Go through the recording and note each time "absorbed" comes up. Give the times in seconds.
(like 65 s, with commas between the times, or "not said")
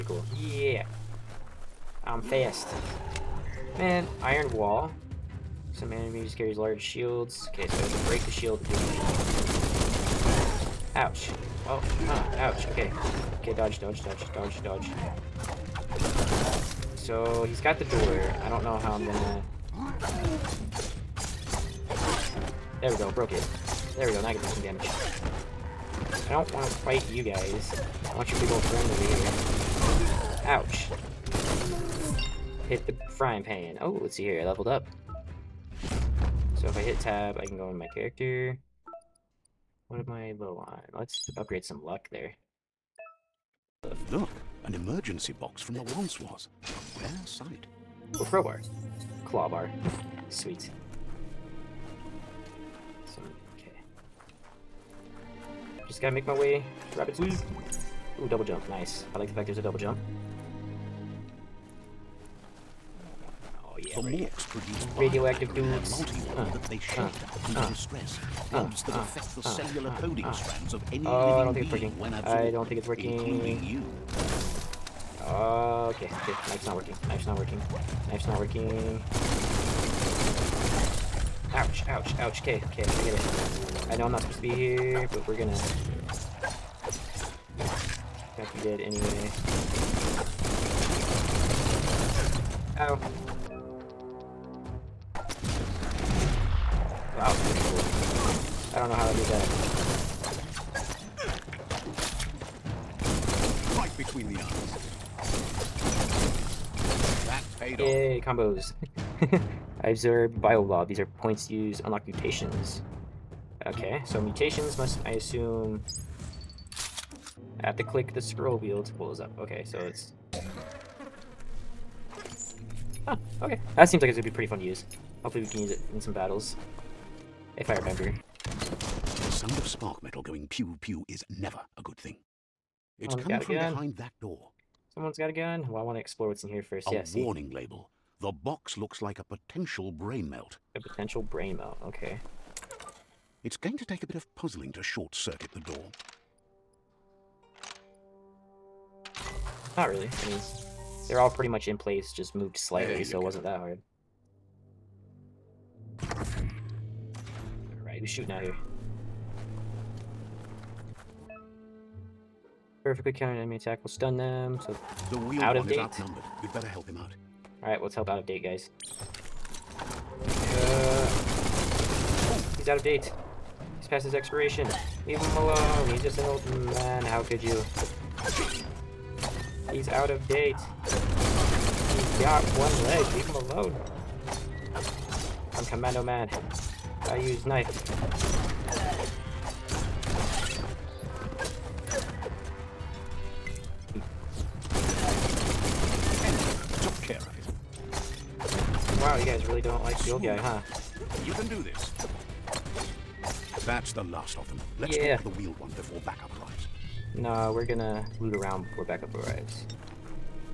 72 s.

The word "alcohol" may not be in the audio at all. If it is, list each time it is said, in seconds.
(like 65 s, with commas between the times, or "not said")
not said.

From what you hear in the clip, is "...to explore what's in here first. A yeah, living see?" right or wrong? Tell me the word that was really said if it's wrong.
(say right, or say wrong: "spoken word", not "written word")
wrong: "warning", not "living".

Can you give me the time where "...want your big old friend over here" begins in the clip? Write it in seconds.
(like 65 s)
28 s.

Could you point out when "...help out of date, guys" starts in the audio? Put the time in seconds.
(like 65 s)
167 s.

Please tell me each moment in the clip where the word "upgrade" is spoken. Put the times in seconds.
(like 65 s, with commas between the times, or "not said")
41 s.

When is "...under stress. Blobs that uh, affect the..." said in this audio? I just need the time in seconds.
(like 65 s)
67 s.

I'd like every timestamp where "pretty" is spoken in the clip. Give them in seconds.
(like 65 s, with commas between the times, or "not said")
124 s, 151 s.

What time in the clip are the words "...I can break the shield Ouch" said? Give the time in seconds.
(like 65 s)
7 s.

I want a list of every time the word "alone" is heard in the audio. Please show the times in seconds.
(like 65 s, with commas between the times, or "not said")
175 s, 183 s.